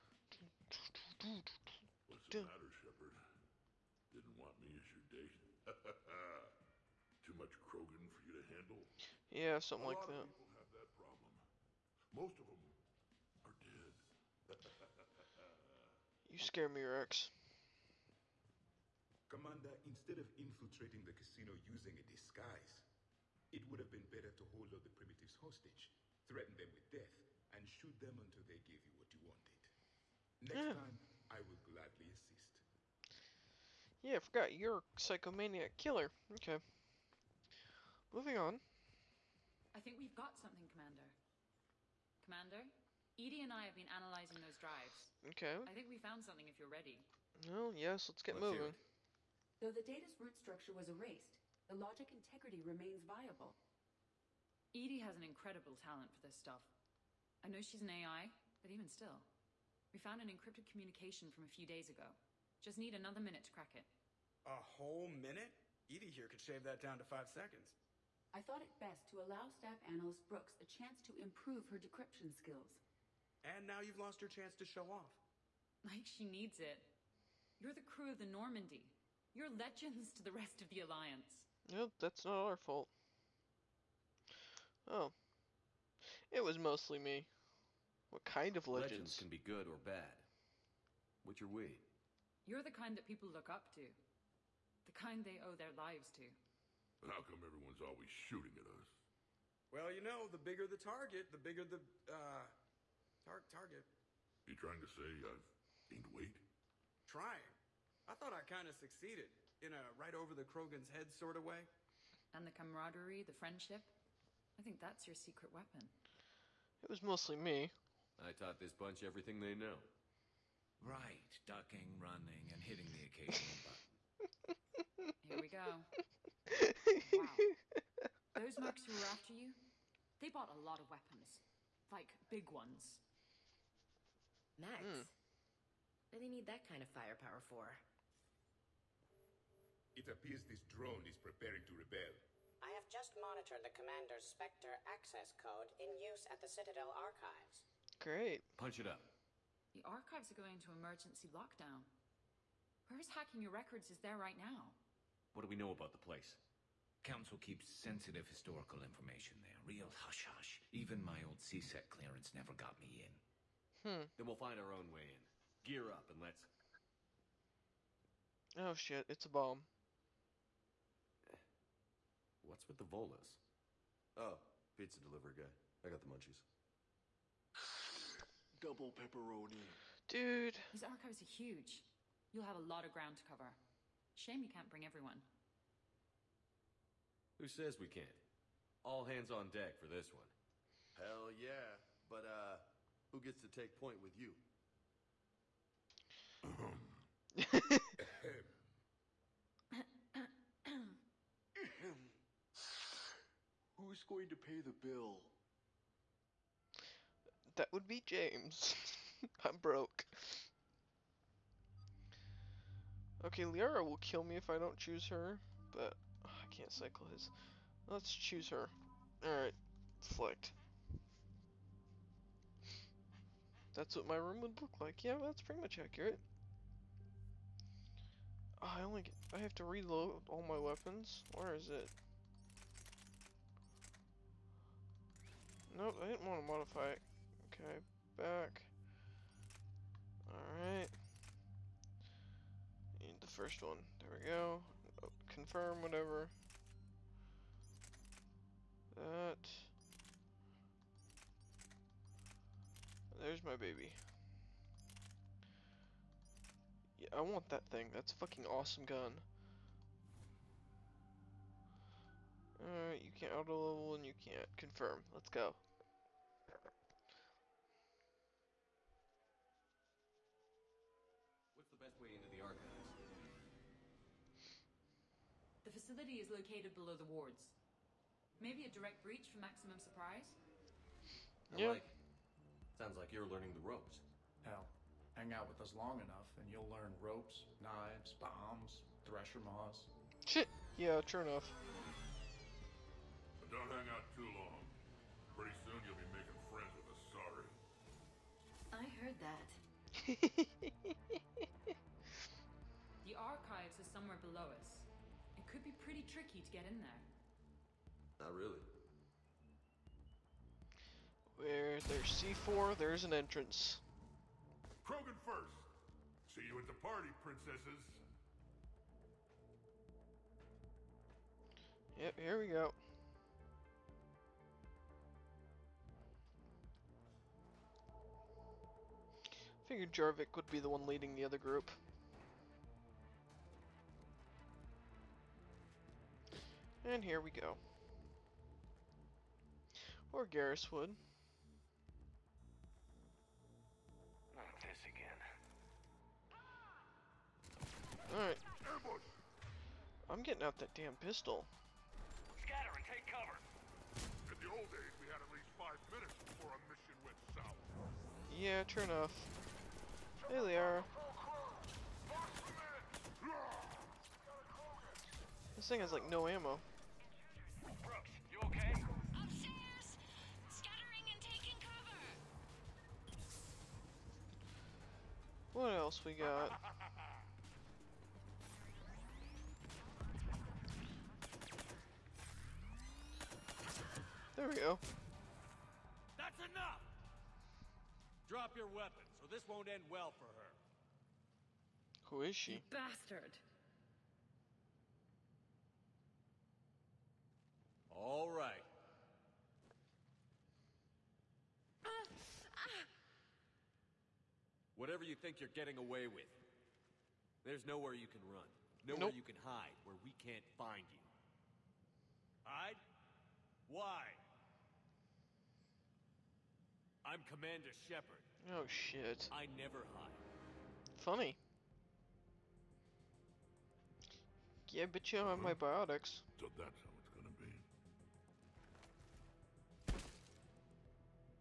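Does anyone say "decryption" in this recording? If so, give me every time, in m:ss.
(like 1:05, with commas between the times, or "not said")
1:11.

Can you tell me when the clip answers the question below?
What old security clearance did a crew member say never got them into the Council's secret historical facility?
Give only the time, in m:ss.
2:41.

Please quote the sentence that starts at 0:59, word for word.
We found an encrypted communication from a few days ago.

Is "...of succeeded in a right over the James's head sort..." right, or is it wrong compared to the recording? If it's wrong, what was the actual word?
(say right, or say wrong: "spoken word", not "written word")
wrong: "Krogan", not "James".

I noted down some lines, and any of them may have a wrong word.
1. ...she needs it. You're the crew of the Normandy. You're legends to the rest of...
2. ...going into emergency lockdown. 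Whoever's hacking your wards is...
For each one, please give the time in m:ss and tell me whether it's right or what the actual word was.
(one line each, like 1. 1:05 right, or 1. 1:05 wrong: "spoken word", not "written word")
1. 1:16 right
2. 2:30 wrong: "records", not "wards".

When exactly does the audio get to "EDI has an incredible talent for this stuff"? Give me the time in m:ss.
0:54.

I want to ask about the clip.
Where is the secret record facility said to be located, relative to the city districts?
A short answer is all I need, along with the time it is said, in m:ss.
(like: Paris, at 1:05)
Below the wards, at 4:36.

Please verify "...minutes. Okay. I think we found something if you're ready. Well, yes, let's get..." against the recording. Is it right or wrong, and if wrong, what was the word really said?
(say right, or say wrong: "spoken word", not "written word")
wrong: "drives", not "minutes".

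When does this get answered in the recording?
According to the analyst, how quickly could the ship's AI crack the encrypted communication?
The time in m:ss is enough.
1:07.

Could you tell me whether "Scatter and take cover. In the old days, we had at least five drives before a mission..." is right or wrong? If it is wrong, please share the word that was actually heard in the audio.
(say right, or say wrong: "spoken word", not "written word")
wrong: "minutes", not "drives".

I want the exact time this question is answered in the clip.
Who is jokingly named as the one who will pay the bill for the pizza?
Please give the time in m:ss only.
3:27.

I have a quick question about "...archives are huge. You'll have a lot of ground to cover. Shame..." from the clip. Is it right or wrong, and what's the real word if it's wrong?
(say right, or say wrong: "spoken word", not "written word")
right.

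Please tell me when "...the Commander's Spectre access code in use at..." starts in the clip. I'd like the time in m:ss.
2:23.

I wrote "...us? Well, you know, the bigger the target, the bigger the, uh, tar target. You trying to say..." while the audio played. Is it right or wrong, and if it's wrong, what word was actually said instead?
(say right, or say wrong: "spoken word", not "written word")
right.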